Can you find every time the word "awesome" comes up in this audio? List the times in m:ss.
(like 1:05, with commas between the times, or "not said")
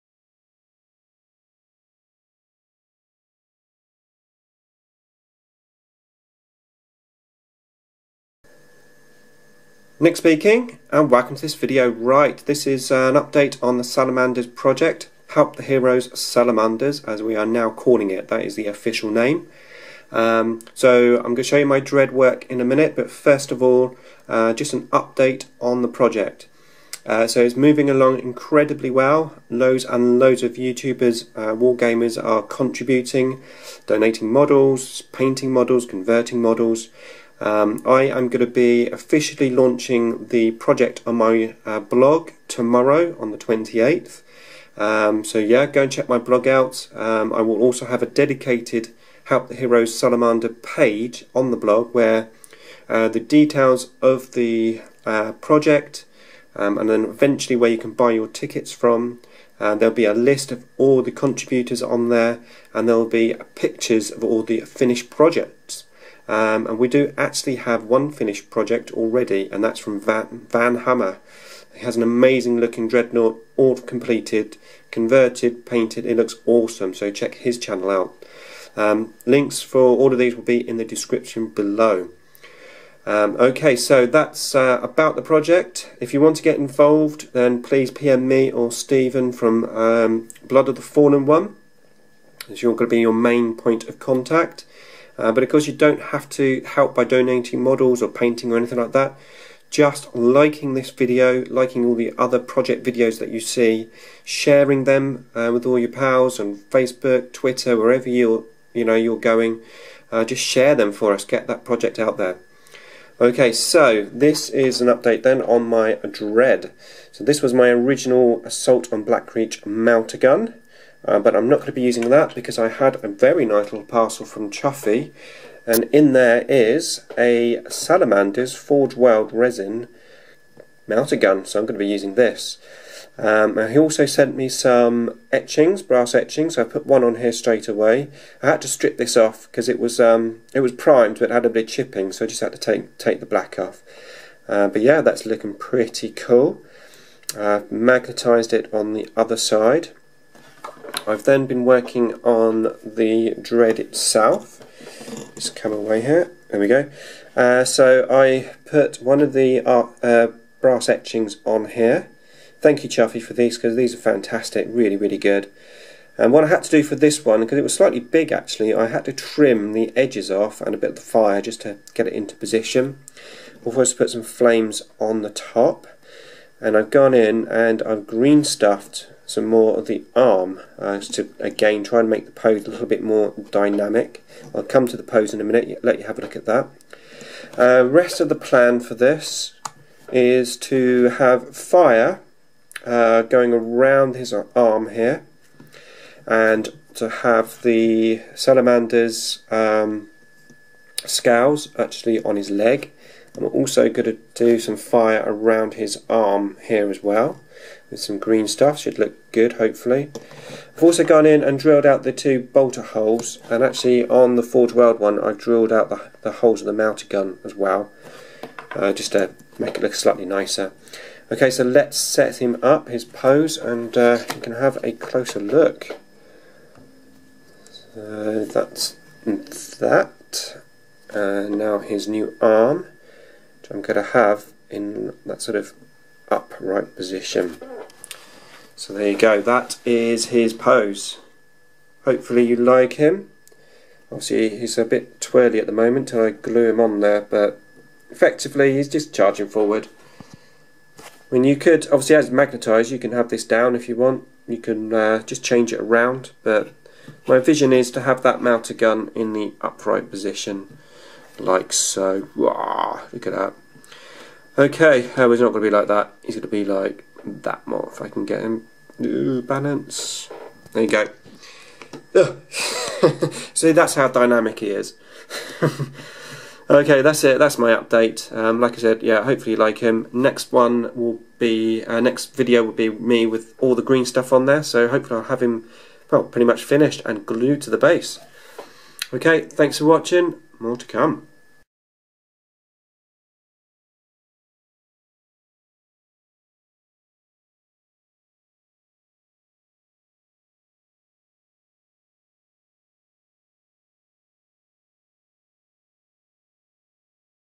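1:16.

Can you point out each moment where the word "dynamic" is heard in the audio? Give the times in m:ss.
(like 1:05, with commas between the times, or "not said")
3:03, 4:34.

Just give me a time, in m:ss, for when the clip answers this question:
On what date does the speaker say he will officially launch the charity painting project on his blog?
0:43.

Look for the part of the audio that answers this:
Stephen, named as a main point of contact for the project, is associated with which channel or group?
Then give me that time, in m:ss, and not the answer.
1:30.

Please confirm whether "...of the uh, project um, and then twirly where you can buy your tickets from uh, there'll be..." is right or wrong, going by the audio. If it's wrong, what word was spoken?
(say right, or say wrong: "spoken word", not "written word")
wrong: "eventually", not "twirly".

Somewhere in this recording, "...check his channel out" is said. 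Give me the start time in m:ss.
1:17.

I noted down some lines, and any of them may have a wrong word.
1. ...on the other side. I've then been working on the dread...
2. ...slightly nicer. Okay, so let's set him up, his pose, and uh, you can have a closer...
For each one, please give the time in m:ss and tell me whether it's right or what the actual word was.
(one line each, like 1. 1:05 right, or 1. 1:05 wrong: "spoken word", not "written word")
1. 2:28 right
2. 3:39 right.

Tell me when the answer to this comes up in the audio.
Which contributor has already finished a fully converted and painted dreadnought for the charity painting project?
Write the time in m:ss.
1:10.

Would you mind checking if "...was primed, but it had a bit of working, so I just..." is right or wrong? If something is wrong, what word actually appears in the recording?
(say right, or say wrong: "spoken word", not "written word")
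wrong: "chipping", not "working".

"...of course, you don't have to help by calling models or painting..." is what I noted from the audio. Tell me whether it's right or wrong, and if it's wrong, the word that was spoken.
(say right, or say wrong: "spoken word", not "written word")
wrong: "donating", not "calling".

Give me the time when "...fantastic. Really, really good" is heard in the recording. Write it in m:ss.
2:43.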